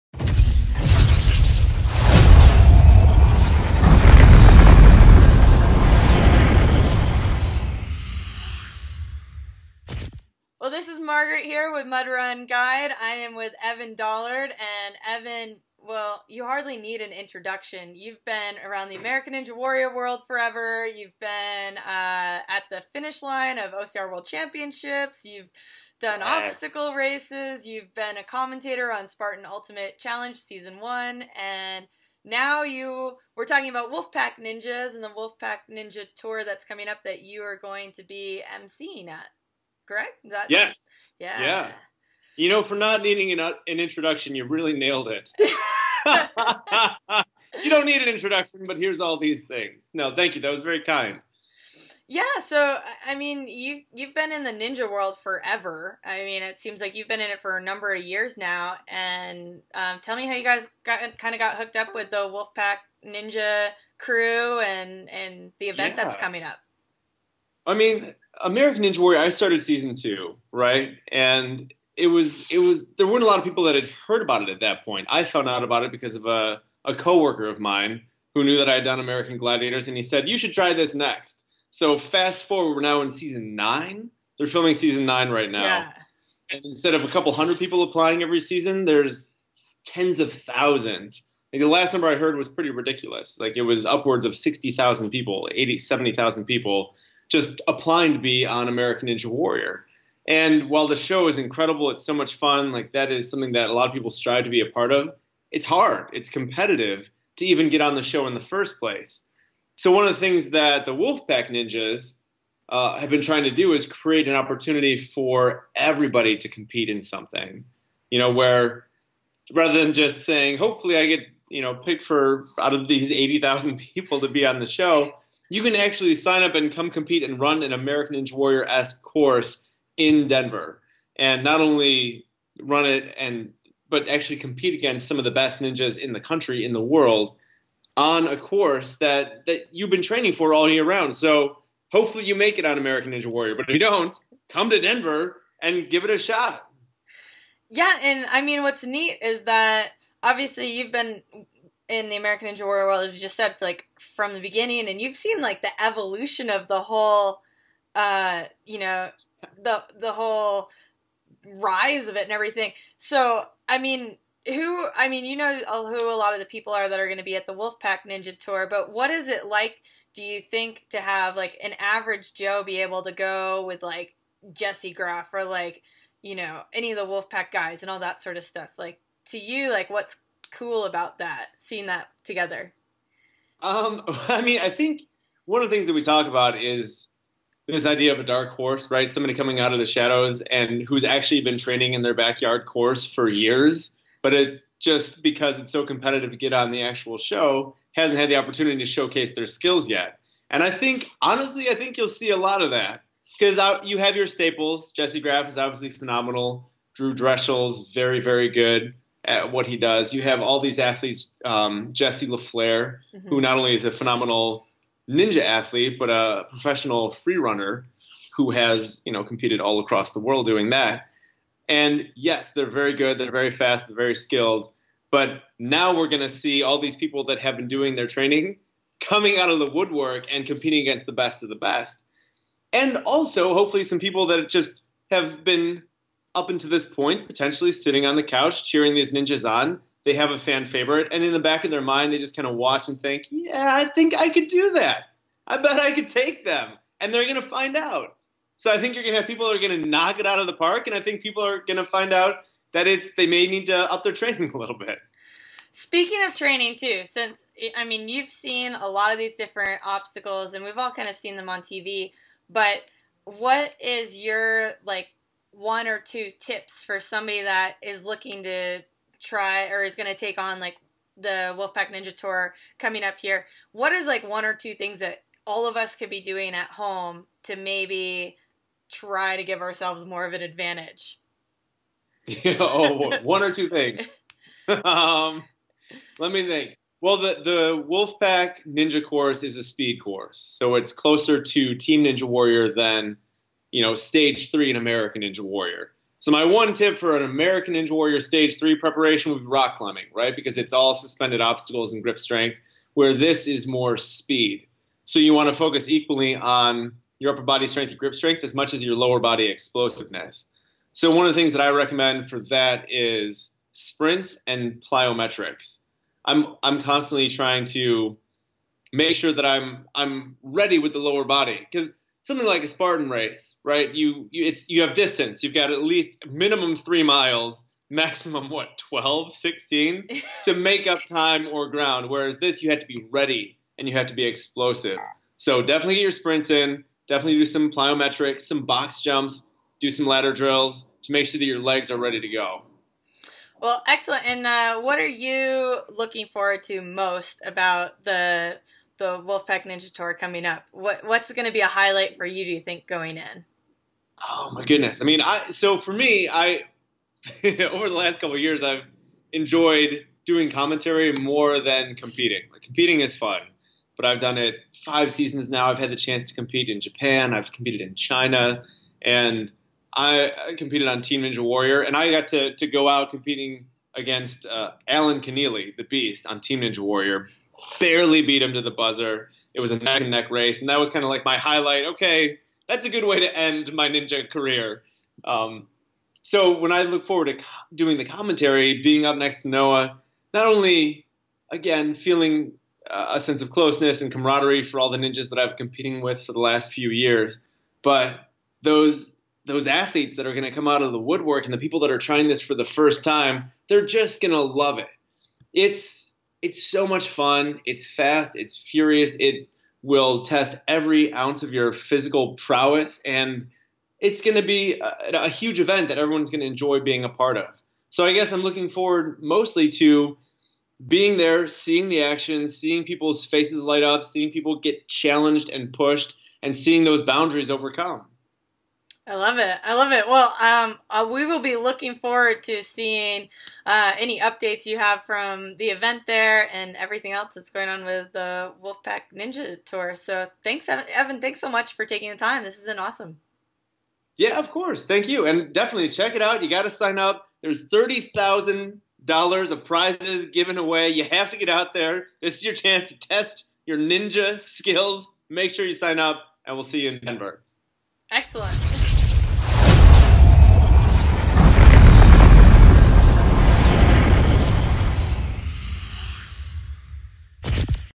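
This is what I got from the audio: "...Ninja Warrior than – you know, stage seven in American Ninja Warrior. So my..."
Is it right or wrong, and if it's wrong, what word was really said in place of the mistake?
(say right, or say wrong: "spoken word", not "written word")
wrong: "three", not "seven".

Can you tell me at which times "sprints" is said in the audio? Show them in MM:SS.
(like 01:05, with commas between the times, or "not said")
05:13, 05:36.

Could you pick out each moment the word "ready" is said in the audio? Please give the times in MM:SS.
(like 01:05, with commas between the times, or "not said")
05:20, 05:33, 05:41.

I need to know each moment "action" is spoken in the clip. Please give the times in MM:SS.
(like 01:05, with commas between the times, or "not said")
07:02.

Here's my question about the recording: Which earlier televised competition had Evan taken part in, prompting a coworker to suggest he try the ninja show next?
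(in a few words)
American Gladiators.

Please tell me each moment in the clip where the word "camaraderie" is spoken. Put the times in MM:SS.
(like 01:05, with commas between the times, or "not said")
06:34.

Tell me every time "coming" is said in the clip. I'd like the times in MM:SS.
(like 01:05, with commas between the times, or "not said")
00:36, 01:06, 03:09, 03:49, 04:32, 05:50.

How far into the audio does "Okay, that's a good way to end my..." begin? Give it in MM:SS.
06:21.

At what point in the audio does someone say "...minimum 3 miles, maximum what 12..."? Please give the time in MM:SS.
05:26.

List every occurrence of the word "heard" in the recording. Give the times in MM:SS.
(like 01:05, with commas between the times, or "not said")
01:14, 01:32.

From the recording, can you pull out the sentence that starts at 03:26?
Drew Drechsel's very, very good at what he does.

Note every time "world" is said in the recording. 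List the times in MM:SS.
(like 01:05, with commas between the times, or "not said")
00:19, 00:24, 00:54, 02:16, 02:32, 03:40.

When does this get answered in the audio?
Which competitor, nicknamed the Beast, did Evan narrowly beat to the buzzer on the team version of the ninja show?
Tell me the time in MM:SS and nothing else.
06:14.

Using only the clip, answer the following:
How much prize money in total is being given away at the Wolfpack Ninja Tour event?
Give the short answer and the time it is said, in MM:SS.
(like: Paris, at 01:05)
$30,000, at 07:27.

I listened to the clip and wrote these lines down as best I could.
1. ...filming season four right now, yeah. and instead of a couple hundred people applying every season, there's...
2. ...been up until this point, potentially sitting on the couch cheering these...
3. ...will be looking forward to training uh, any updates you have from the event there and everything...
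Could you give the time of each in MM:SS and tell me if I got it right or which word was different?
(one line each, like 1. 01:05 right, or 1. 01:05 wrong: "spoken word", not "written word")
1. 01:24 wrong: "nine", not "four"
2. 03:55 right
3. 07:11 wrong: "seeing", not "training".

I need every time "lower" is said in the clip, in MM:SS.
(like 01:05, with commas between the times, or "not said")
05:08, 05:20.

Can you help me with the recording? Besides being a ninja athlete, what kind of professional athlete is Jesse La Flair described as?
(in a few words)
Free runner.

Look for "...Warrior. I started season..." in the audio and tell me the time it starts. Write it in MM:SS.
01:08.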